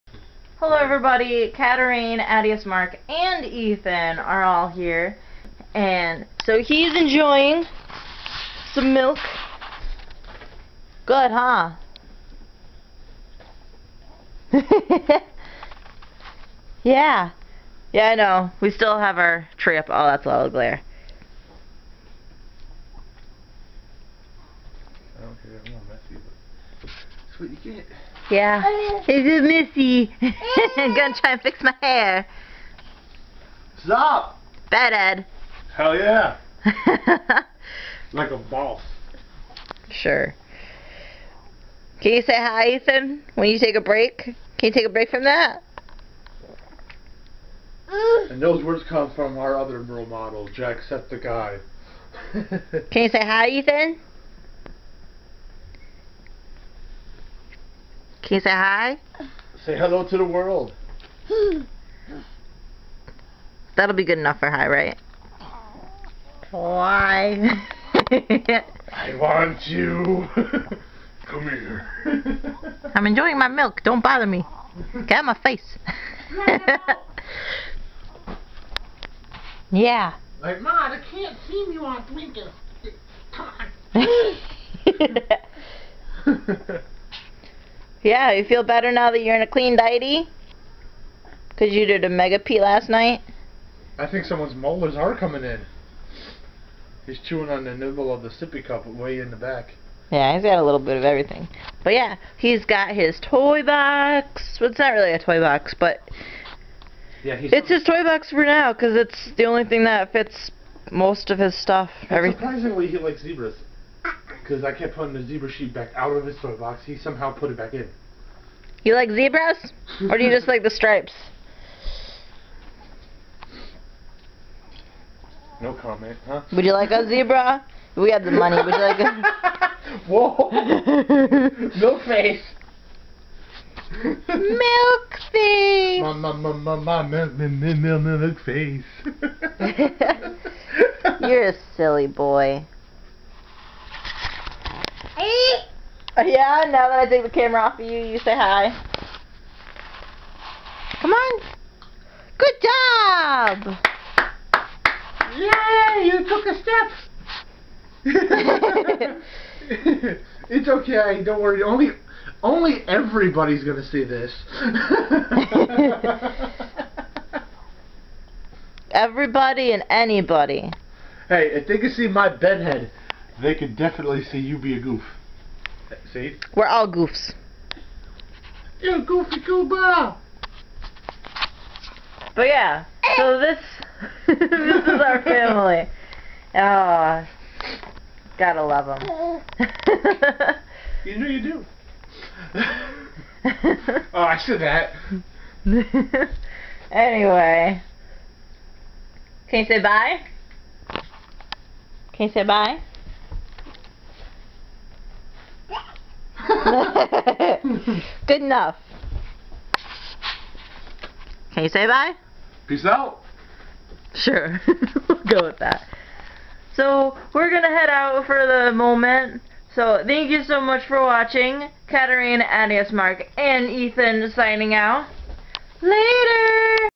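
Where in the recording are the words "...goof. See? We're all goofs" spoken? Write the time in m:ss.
2:54.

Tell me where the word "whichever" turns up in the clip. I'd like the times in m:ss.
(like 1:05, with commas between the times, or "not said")
not said.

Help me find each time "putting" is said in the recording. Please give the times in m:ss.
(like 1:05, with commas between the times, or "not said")
1:54.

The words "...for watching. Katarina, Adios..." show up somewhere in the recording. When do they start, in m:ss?
3:40.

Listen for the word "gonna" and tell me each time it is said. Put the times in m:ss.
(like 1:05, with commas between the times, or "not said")
0:30, 2:43.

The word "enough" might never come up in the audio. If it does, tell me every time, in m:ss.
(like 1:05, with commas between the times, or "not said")
1:04, 3:28.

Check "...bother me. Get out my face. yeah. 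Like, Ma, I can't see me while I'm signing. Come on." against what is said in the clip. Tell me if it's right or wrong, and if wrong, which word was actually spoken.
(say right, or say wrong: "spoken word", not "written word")
wrong: "drinking", not "signing".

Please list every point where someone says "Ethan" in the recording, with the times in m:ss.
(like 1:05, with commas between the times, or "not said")
0:03, 0:42, 0:53, 3:43.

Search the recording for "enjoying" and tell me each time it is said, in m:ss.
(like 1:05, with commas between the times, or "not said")
0:06, 1:13.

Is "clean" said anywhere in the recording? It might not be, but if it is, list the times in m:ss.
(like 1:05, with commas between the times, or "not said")
1:29.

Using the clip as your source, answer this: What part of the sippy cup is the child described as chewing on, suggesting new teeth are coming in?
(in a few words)
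The nibble.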